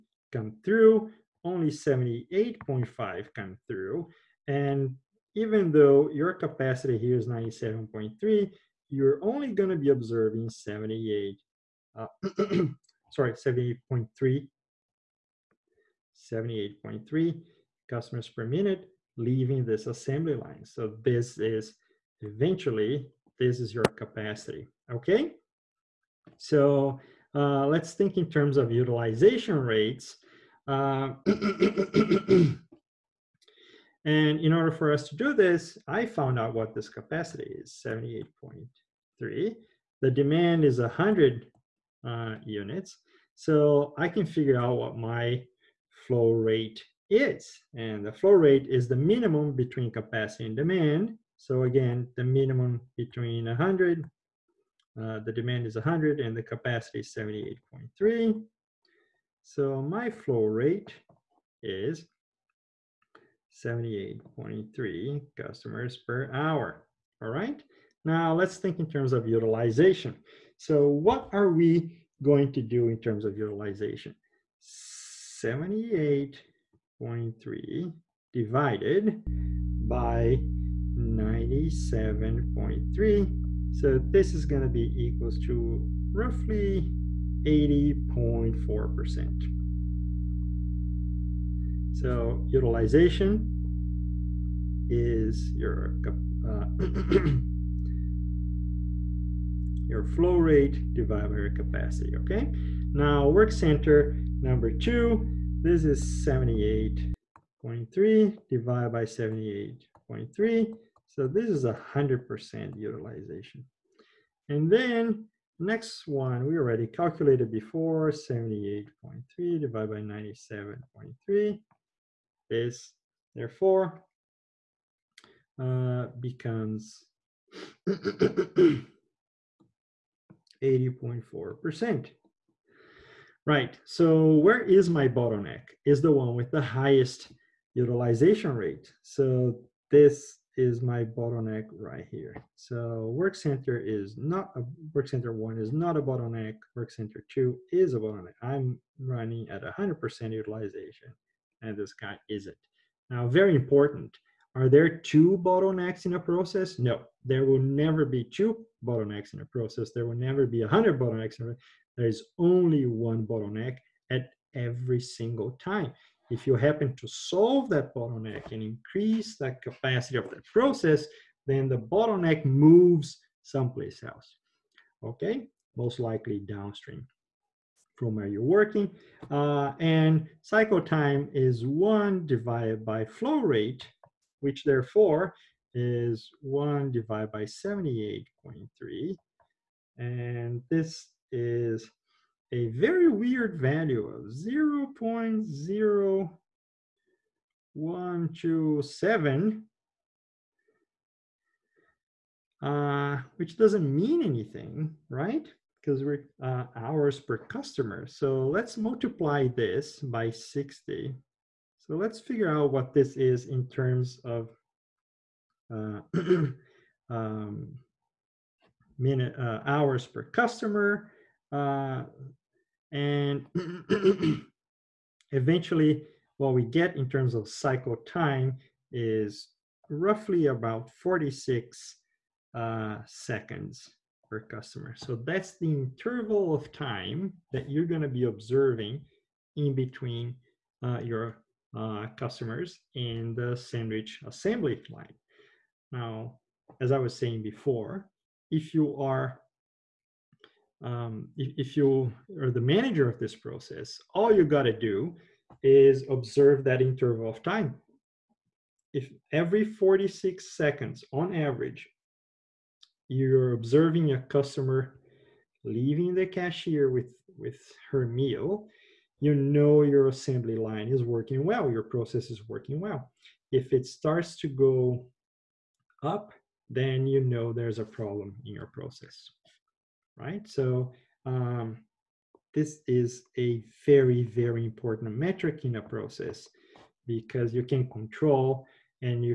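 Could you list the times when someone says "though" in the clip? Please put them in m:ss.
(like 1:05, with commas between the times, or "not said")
0:05.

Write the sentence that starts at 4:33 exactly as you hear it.
If it starts to go up, then you know there's a problem in your process right?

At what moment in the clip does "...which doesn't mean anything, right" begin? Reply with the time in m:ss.
3:23.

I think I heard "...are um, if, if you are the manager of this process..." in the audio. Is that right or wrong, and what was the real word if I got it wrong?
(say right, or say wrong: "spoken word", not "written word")
right.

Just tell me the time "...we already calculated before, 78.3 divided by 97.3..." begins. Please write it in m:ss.
1:56.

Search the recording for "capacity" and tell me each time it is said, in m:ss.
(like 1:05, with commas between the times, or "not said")
0:06, 0:23, 0:36, 0:49, 0:56, 1:41, 2:49.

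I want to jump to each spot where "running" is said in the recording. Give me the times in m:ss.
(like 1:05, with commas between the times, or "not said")
2:28.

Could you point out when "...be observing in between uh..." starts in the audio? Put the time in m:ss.
3:58.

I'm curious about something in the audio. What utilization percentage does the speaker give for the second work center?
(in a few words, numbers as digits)
100%.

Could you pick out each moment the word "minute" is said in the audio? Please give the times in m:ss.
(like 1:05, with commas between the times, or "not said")
0:18, 3:38.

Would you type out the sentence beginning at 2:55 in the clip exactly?
Okay, most likely downstream from where you're working.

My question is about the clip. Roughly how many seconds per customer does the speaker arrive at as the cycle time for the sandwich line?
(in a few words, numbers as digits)
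46 seconds.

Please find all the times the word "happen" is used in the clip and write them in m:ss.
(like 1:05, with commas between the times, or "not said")
2:46.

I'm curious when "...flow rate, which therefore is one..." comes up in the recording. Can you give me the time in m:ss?
3:03.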